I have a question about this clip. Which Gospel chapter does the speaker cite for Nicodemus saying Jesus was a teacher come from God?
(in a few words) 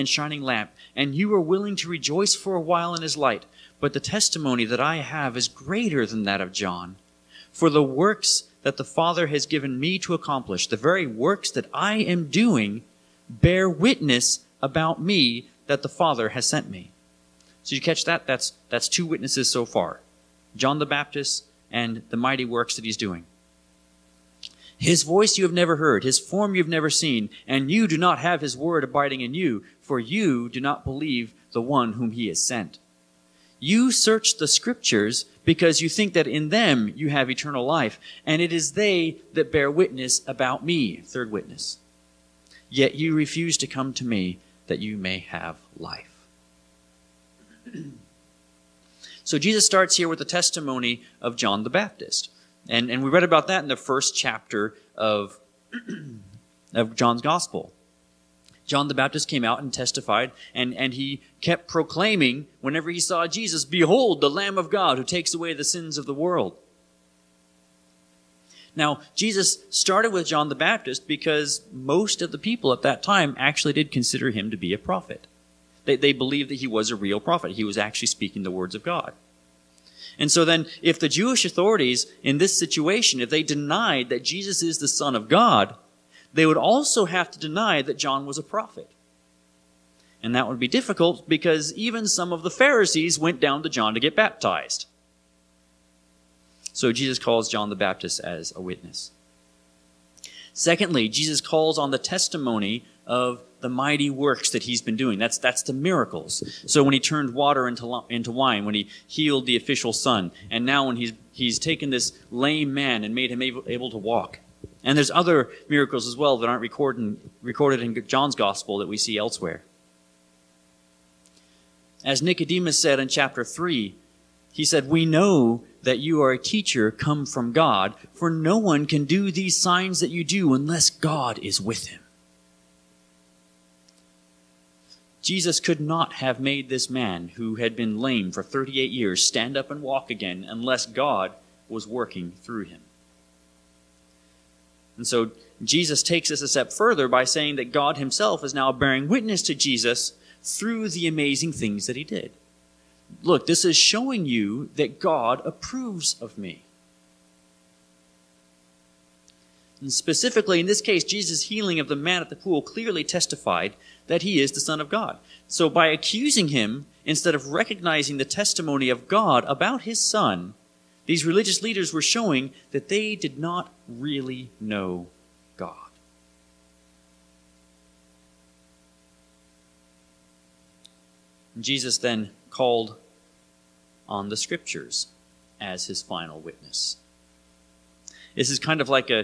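Chapter 3.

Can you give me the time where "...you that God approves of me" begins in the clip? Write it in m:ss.
2:34.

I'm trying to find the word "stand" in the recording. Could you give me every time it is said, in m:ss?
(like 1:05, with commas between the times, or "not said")
2:19.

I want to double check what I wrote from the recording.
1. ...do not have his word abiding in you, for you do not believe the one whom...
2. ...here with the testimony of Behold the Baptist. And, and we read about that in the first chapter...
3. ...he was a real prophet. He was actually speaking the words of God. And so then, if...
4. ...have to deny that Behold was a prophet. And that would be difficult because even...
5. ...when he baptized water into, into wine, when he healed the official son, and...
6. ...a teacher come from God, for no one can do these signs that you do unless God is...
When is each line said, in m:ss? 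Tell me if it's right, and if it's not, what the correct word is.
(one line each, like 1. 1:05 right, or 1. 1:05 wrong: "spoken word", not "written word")
1. 0:27 right
2. 0:49 wrong: "John", not "Behold"
3. 1:16 right
4. 1:27 wrong: "John", not "Behold"
5. 1:46 wrong: "turned", not "baptized"
6. 2:06 right.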